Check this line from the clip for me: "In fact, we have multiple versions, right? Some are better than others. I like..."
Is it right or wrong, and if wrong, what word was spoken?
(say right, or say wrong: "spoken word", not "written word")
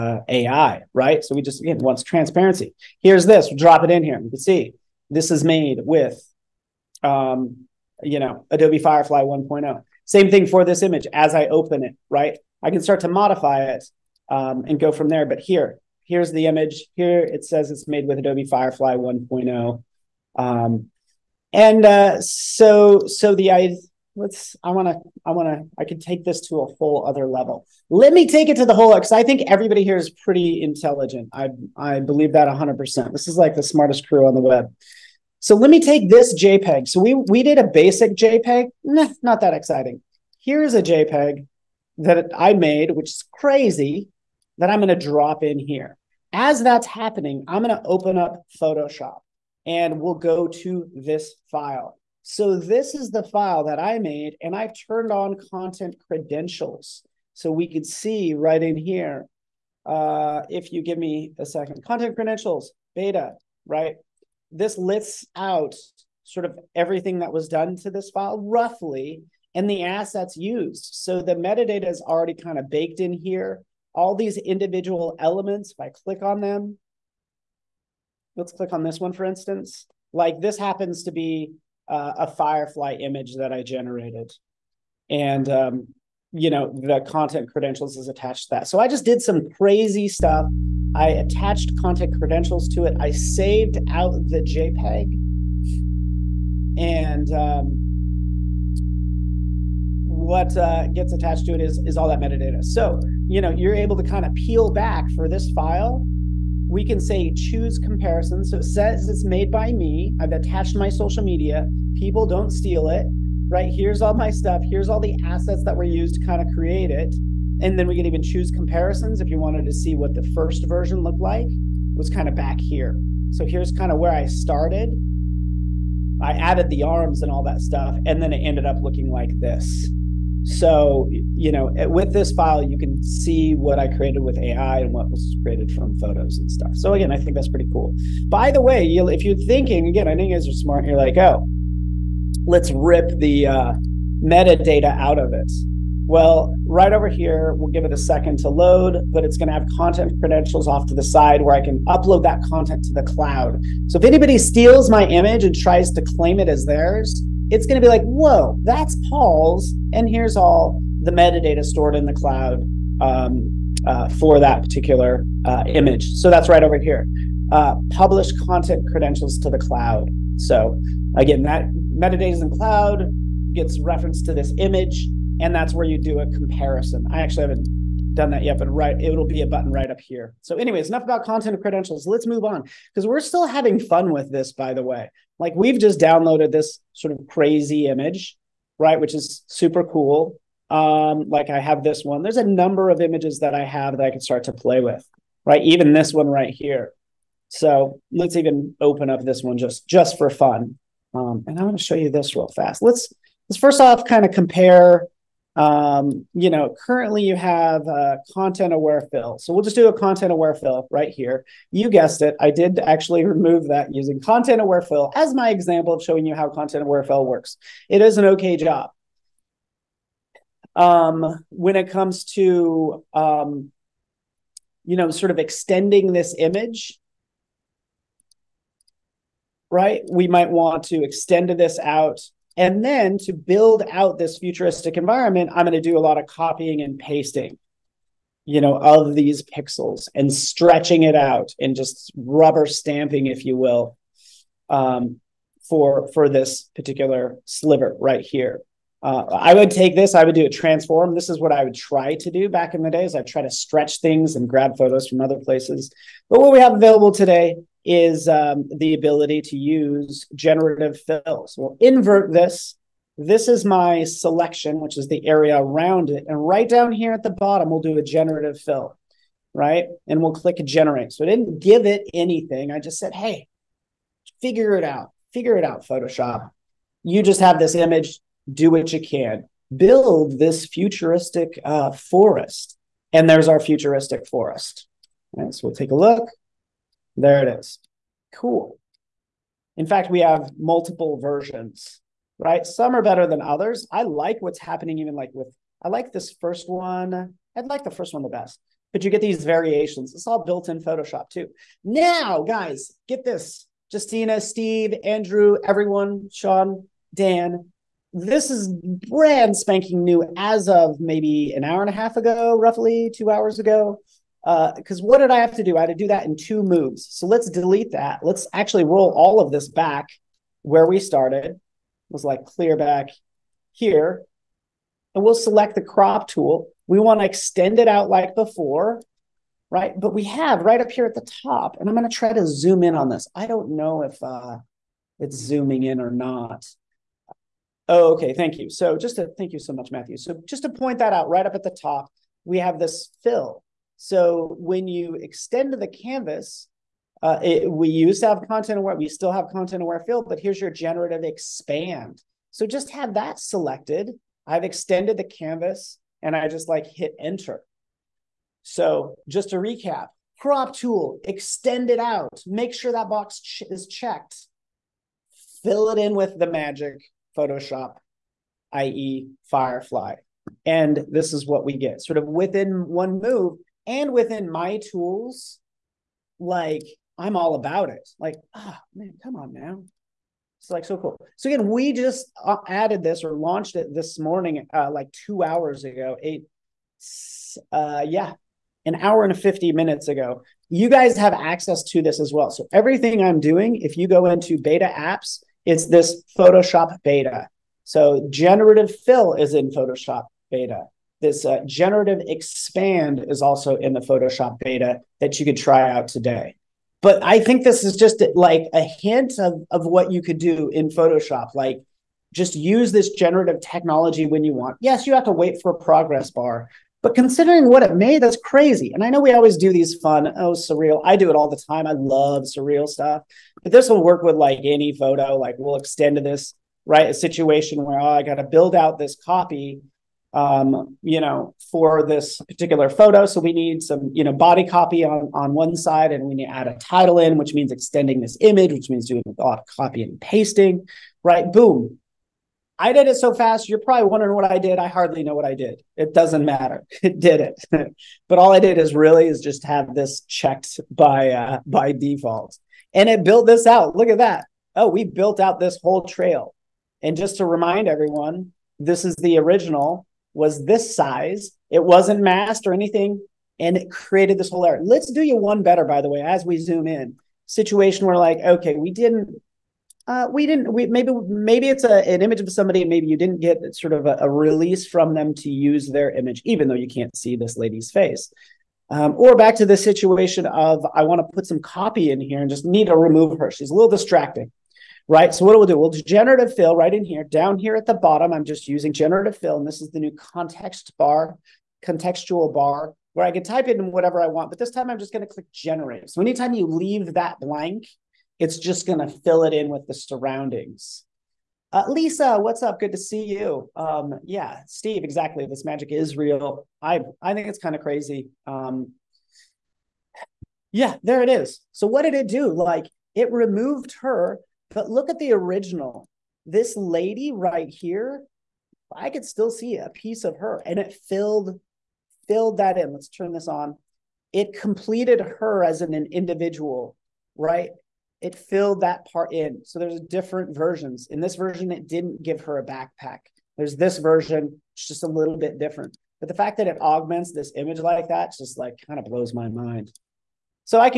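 right.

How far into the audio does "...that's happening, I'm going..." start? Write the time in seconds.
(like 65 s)
46 s.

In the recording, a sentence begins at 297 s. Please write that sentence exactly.
I'd like the first one the best, but you get these variations.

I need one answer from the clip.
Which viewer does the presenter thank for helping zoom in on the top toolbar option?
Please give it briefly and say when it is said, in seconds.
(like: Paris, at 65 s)
Matthew, at 339 s.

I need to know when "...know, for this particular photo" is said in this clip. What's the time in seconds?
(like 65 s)
431 s.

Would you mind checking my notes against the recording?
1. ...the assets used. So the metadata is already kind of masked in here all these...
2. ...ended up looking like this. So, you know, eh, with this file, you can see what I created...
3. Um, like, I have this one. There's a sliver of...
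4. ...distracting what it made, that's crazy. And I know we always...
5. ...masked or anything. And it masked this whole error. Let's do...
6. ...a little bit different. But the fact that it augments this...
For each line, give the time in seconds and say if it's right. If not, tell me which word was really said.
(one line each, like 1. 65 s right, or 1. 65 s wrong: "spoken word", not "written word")
1. 69 s wrong: "baked", not "masked"
2. 128 s right
3. 190 s wrong: "number", not "sliver"
4. 417 s wrong: "considering", not "distracting"
5. 462 s wrong: "created", not "masked"
6. 535 s right.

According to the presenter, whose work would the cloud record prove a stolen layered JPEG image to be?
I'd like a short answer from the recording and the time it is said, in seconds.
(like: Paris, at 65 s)
Paul's, at 159 s.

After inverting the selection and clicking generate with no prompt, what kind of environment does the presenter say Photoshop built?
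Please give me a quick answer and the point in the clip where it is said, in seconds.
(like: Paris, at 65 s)
futuristic forest, at 283 s.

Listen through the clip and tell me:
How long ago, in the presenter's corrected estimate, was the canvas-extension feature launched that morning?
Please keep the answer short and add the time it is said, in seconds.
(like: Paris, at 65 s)
an hour and 50 minutes, at 388 s.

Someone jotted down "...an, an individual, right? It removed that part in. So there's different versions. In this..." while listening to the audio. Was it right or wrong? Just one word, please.
wrong.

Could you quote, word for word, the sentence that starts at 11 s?
As I open it, right, I can start to modify it um, and go from there.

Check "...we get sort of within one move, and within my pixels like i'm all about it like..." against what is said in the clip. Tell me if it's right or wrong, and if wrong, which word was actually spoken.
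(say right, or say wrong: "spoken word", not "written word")
wrong: "tools", not "pixels".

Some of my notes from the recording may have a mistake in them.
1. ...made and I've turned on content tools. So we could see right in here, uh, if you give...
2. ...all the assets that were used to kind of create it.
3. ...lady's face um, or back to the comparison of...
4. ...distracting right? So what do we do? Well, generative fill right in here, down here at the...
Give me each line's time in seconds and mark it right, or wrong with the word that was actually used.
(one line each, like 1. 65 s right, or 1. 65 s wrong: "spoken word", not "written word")
1. 53 s wrong: "credentials", not "tools"
2. 114 s right
3. 477 s wrong: "situation", not "comparison"
4. 483 s right.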